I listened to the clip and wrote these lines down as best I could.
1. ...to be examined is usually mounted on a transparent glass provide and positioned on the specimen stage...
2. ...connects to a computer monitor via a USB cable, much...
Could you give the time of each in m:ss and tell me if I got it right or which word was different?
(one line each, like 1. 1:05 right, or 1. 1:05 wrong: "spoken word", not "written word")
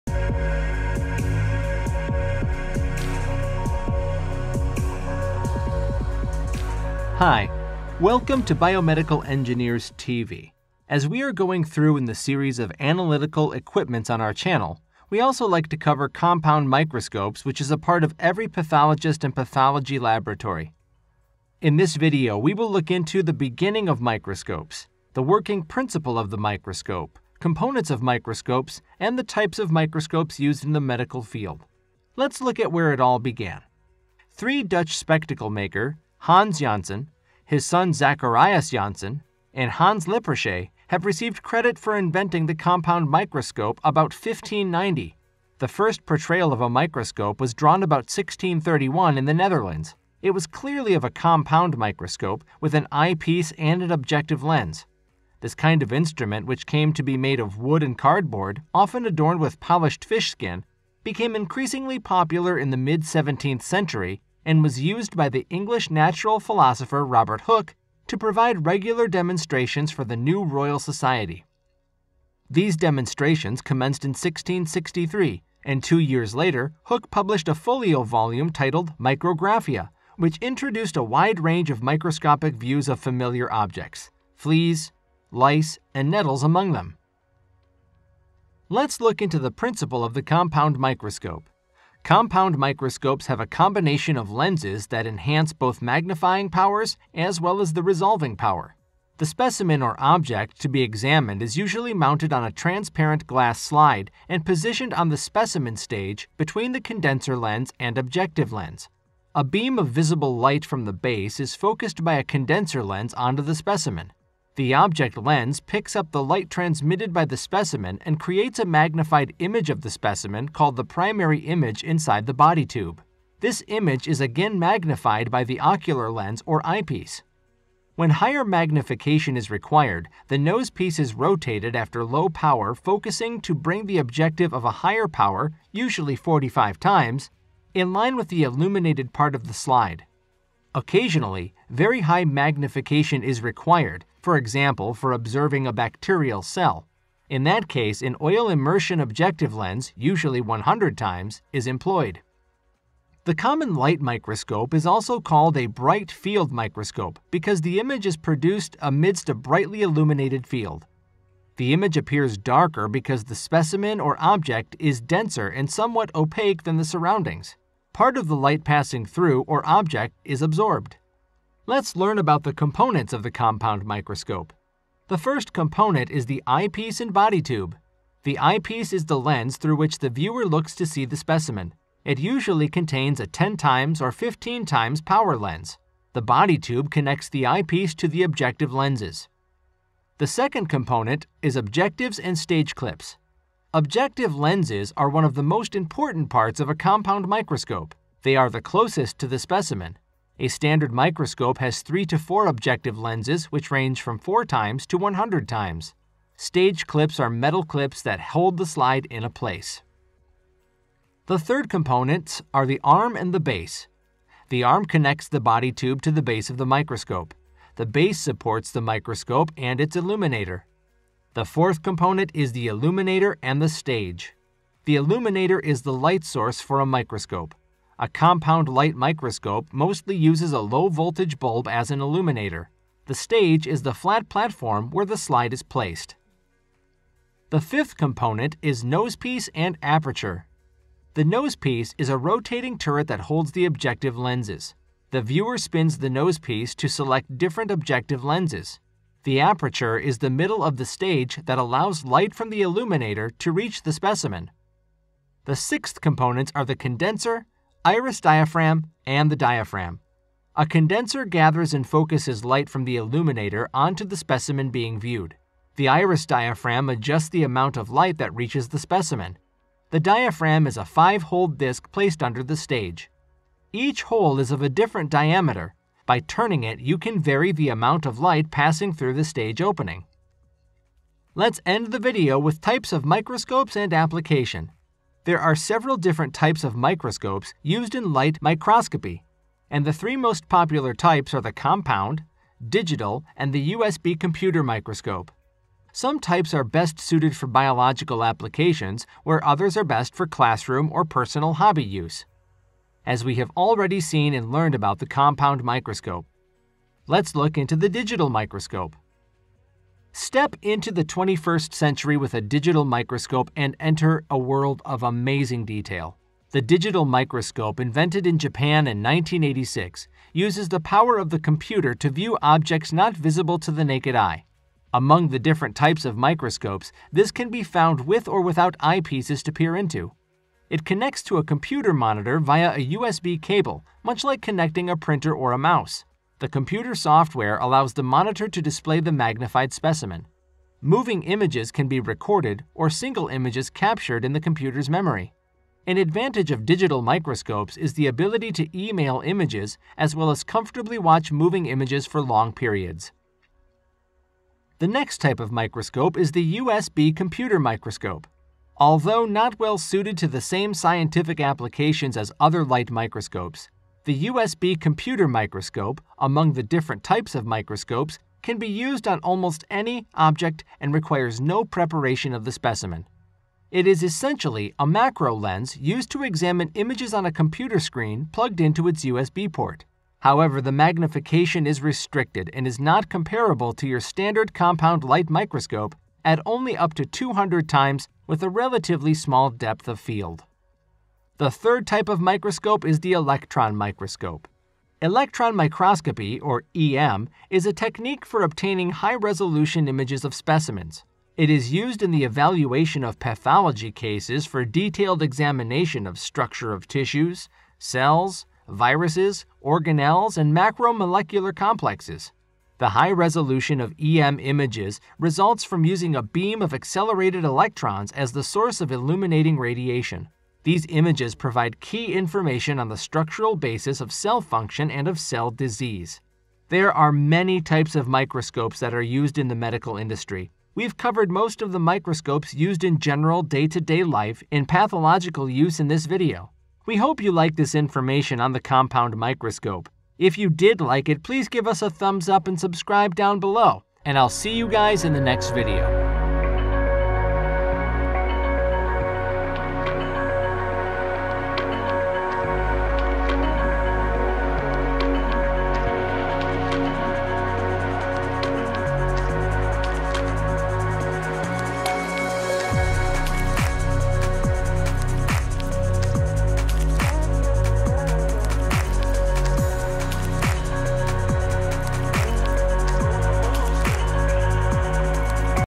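1. 1:40 wrong: "slide", not "provide"
2. 5:30 right.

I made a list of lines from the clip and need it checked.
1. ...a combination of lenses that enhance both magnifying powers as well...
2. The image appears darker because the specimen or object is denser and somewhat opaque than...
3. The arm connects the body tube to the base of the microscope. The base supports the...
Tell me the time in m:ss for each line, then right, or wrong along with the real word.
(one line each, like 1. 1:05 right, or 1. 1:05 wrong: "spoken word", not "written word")
1. 1:33 right
2. 2:41 right
3. 3:34 right.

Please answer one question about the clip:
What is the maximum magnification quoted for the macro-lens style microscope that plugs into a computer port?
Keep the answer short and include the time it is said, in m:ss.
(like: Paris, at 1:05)
200 times, at 6:27.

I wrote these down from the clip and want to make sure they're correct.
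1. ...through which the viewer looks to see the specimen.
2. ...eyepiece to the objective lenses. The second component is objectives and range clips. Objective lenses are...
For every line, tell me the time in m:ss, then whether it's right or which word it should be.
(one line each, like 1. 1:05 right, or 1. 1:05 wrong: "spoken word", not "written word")
1. 2:59 right
2. 3:07 wrong: "stage", not "range".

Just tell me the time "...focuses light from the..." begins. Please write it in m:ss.
4:21.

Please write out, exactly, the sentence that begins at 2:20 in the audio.
Occasionally, very high magnification is required, for example, for observing a bacterial cell.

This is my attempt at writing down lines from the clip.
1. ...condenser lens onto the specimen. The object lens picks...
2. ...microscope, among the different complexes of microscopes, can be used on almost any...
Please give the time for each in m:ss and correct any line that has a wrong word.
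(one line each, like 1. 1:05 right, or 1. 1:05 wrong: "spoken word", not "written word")
1. 1:52 right
2. 6:05 wrong: "types", not "complexes".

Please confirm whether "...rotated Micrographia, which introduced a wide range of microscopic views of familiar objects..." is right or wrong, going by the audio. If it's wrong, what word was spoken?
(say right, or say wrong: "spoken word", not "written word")
wrong: "titled", not "rotated".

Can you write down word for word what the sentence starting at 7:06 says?
There are many types of microscopes that are used in the medical industry.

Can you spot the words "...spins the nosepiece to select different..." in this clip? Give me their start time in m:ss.
4:05.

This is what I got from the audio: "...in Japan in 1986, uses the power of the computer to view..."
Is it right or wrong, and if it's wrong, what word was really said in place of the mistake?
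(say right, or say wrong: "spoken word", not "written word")
right.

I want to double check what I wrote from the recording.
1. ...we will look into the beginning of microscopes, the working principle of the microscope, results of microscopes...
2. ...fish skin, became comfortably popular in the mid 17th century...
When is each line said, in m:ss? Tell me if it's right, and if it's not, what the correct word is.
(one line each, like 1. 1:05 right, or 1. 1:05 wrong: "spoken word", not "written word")
1. 0:22 wrong: "components", not "results"
2. 1:00 wrong: "increasingly", not "comfortably".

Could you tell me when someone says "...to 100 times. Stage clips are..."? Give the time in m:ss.
3:24.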